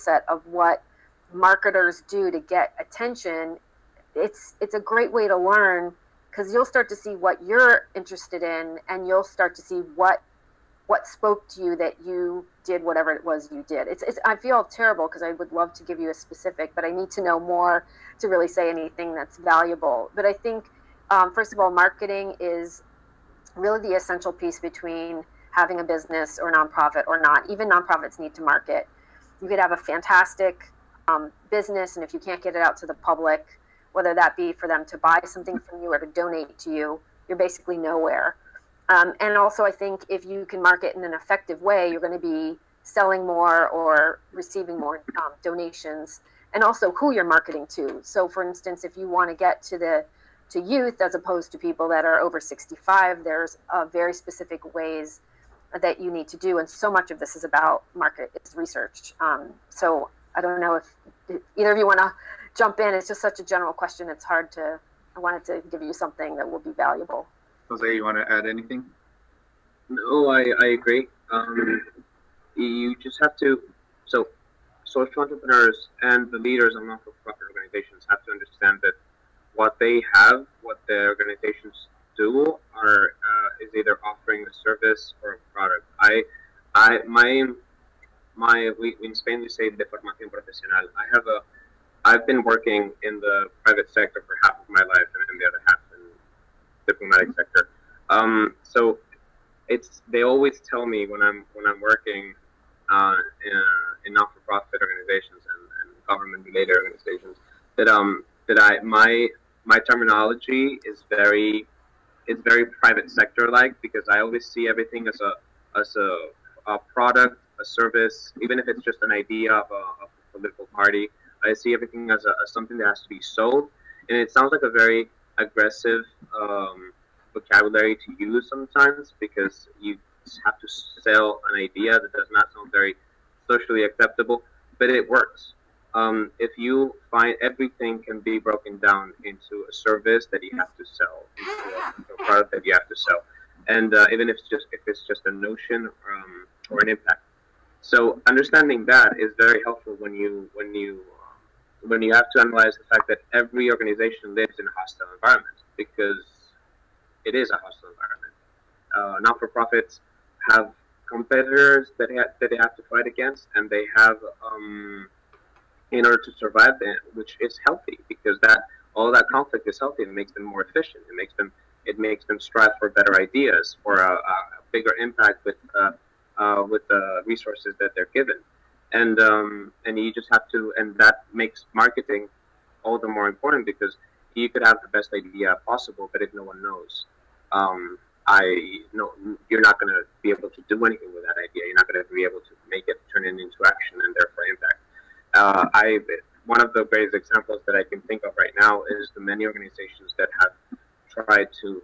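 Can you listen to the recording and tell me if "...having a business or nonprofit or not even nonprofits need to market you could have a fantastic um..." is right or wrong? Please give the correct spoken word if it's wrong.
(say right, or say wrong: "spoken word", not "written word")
right.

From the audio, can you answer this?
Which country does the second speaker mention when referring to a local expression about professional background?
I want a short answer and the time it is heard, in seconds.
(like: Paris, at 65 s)
Spain, at 89 s.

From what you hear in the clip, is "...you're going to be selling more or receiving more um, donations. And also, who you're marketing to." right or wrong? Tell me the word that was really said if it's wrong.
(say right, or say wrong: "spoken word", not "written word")
right.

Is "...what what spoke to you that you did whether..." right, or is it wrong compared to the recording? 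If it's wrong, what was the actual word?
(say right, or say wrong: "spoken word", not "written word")
wrong: "whatever", not "whether".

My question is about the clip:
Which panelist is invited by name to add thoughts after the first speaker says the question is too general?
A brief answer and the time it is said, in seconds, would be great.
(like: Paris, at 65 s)
Jose, at 67 s.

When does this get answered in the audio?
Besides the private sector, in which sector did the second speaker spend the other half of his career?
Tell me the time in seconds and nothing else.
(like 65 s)
96 s.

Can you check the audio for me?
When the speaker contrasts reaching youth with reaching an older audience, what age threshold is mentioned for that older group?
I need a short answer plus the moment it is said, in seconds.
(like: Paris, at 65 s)
over 65, at 52 s.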